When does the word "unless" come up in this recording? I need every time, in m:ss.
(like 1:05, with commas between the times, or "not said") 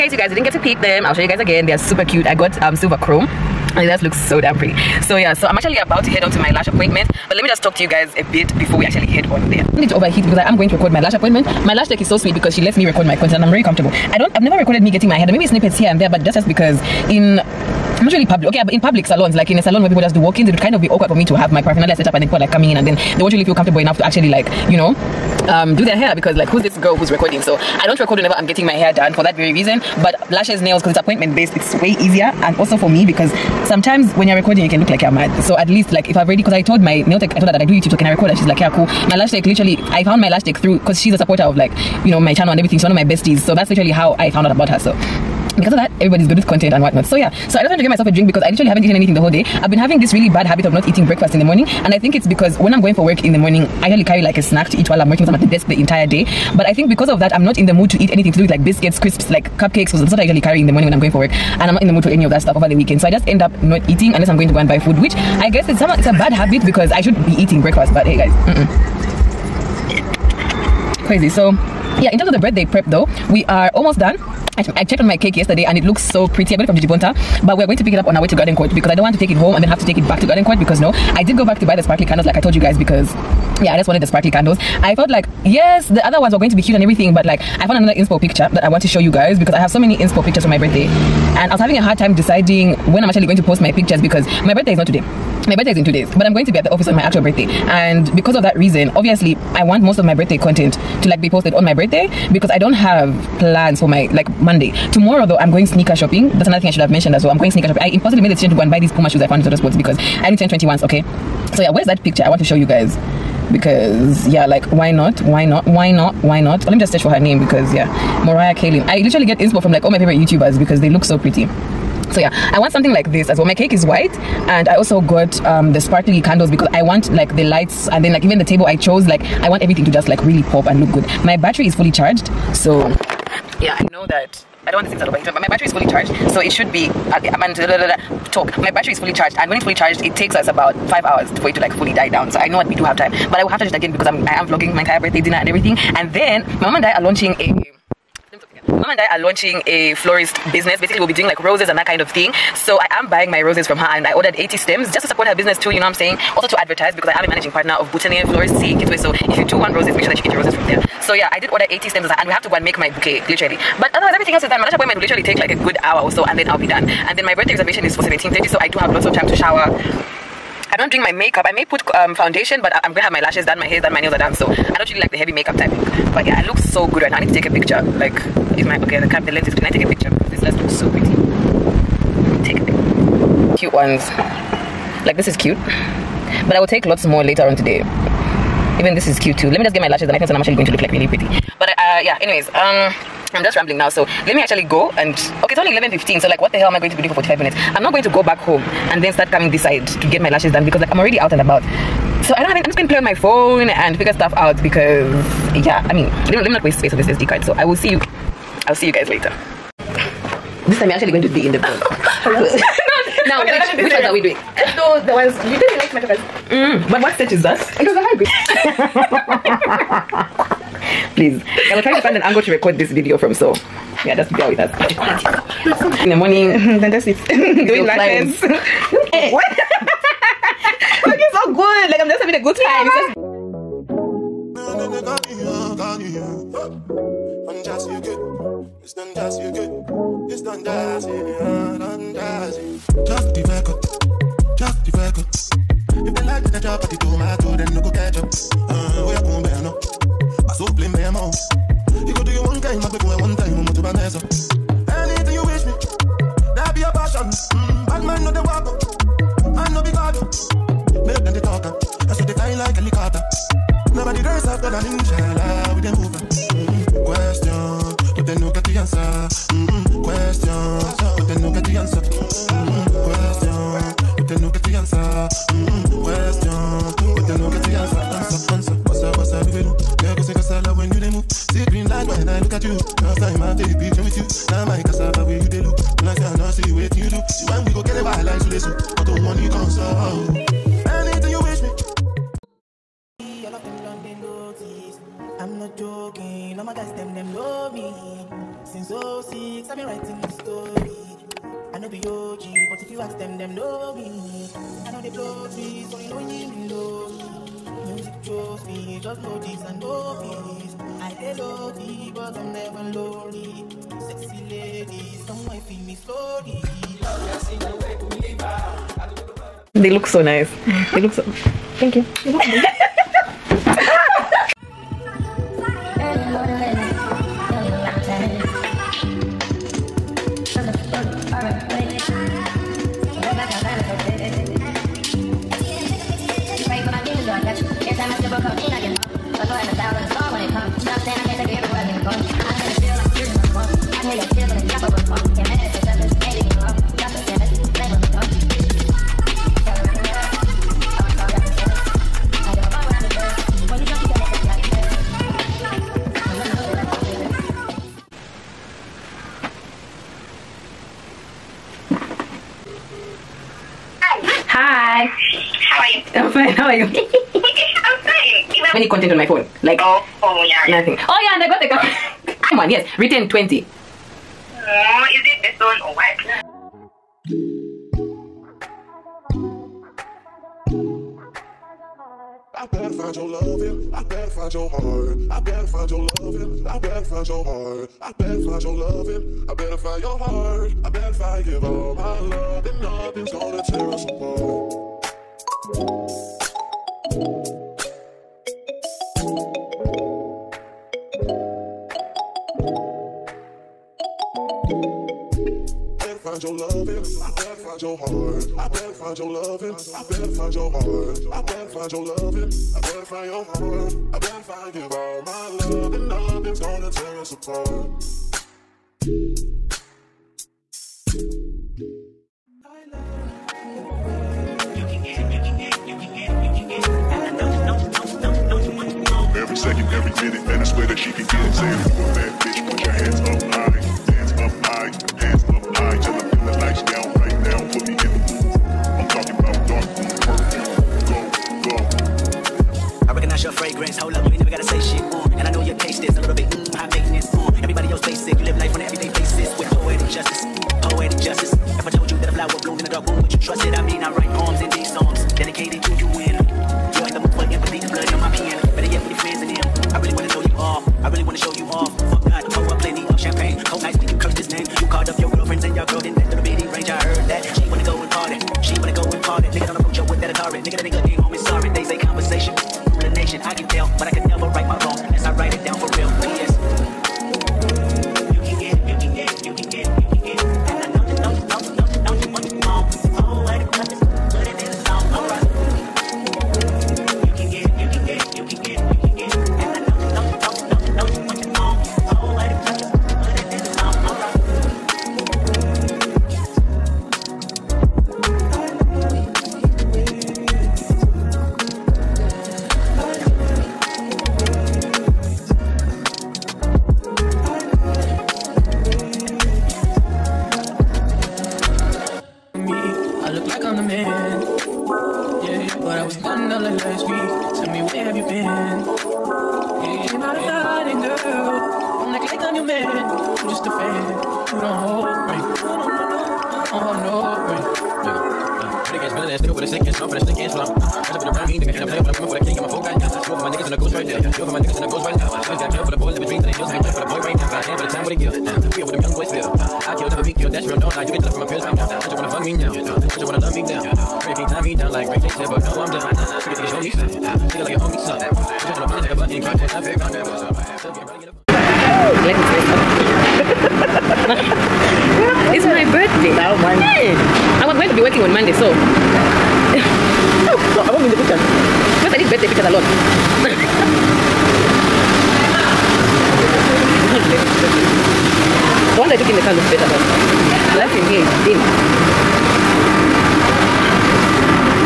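1:04.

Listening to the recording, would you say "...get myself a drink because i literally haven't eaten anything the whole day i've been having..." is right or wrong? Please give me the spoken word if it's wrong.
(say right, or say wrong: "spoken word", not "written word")
right.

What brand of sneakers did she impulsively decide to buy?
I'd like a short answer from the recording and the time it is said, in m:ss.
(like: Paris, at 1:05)
Puma, at 1:48.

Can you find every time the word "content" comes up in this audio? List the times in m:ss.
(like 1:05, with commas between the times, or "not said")
0:13, 0:46, 1:40, 6:09.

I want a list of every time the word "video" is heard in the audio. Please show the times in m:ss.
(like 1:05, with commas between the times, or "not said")
3:42.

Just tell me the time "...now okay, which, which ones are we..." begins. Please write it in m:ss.
3:33.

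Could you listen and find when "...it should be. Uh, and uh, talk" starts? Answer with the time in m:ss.
2:16.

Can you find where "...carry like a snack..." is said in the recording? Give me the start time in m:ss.
0:54.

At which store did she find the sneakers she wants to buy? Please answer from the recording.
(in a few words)
Total Sports.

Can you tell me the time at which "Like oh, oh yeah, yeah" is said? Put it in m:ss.
6:09.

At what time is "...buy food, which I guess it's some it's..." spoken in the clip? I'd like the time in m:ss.
1:04.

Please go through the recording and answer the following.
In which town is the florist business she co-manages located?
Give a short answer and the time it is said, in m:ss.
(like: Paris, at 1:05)
Kitwe, at 2:38.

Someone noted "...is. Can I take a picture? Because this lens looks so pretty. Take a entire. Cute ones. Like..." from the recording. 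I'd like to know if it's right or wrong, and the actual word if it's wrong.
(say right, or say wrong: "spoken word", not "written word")
wrong: "picture", not "entire".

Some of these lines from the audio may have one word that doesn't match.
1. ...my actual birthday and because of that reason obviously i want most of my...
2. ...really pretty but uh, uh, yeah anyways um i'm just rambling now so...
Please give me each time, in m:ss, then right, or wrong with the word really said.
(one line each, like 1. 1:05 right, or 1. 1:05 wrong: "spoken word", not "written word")
1. 1:36 right
2. 3:10 right.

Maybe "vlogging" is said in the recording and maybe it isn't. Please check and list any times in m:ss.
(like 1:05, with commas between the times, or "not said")
2:24.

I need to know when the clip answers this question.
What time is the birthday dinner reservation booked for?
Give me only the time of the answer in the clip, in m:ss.
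2:48.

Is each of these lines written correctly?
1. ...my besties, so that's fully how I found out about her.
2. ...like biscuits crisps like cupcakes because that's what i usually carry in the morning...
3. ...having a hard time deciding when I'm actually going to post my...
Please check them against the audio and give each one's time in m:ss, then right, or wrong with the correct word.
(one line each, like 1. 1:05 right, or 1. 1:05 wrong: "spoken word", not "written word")
1. 0:42 wrong: "literally", not "fully"
2. 0:58 right
3. 1:31 right.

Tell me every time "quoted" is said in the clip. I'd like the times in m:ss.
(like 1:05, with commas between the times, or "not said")
not said.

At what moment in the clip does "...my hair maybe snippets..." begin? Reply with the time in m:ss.
0:15.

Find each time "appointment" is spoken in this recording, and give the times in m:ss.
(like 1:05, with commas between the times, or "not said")
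0:06, 0:11, 0:30, 2:44.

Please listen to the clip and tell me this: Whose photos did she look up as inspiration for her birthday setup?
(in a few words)
Mariah Kaylin.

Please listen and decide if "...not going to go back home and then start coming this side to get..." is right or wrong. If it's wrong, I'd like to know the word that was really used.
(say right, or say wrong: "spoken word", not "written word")
right.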